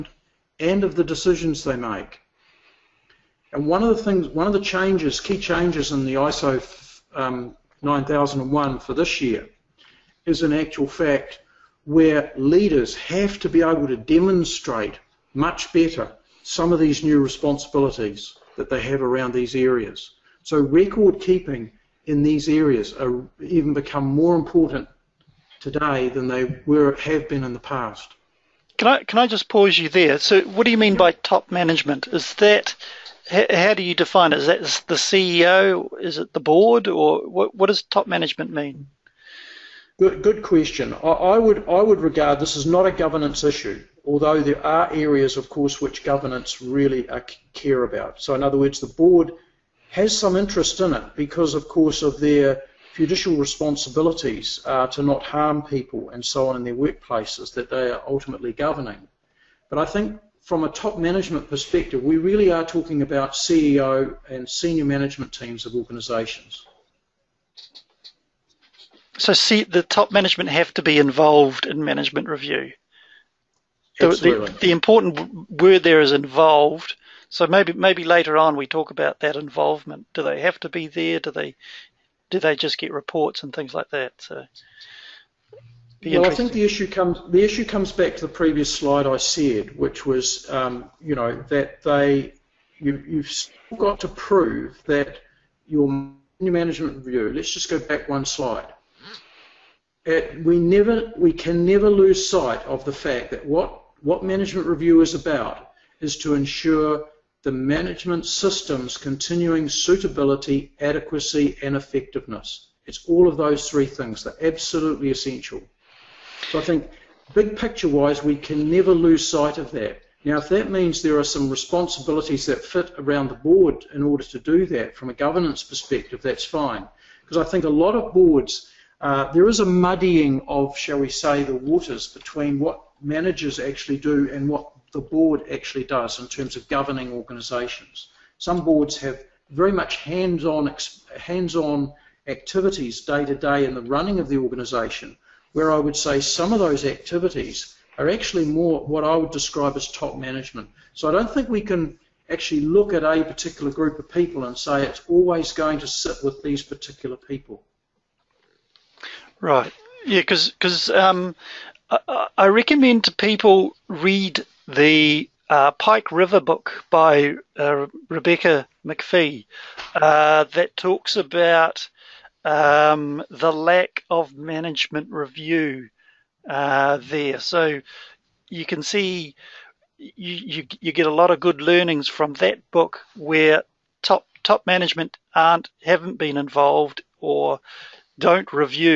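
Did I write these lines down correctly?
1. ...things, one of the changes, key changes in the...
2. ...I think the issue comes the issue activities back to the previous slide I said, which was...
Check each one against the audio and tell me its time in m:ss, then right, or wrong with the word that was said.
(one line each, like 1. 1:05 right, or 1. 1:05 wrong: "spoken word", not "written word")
1. 0:04 right
2. 1:26 wrong: "comes", not "activities".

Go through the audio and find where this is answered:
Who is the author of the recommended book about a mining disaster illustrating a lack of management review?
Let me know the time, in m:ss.
2:48.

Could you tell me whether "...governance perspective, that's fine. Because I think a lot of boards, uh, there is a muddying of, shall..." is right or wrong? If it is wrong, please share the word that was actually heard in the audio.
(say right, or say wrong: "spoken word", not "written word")
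right.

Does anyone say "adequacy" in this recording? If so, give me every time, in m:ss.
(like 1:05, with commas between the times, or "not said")
1:50.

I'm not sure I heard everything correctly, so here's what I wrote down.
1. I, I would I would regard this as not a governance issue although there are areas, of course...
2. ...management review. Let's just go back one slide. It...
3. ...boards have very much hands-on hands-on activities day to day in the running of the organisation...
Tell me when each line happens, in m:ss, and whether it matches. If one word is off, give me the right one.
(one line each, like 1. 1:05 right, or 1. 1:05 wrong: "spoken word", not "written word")
1. 0:40 right
2. 1:36 right
3. 2:18 right.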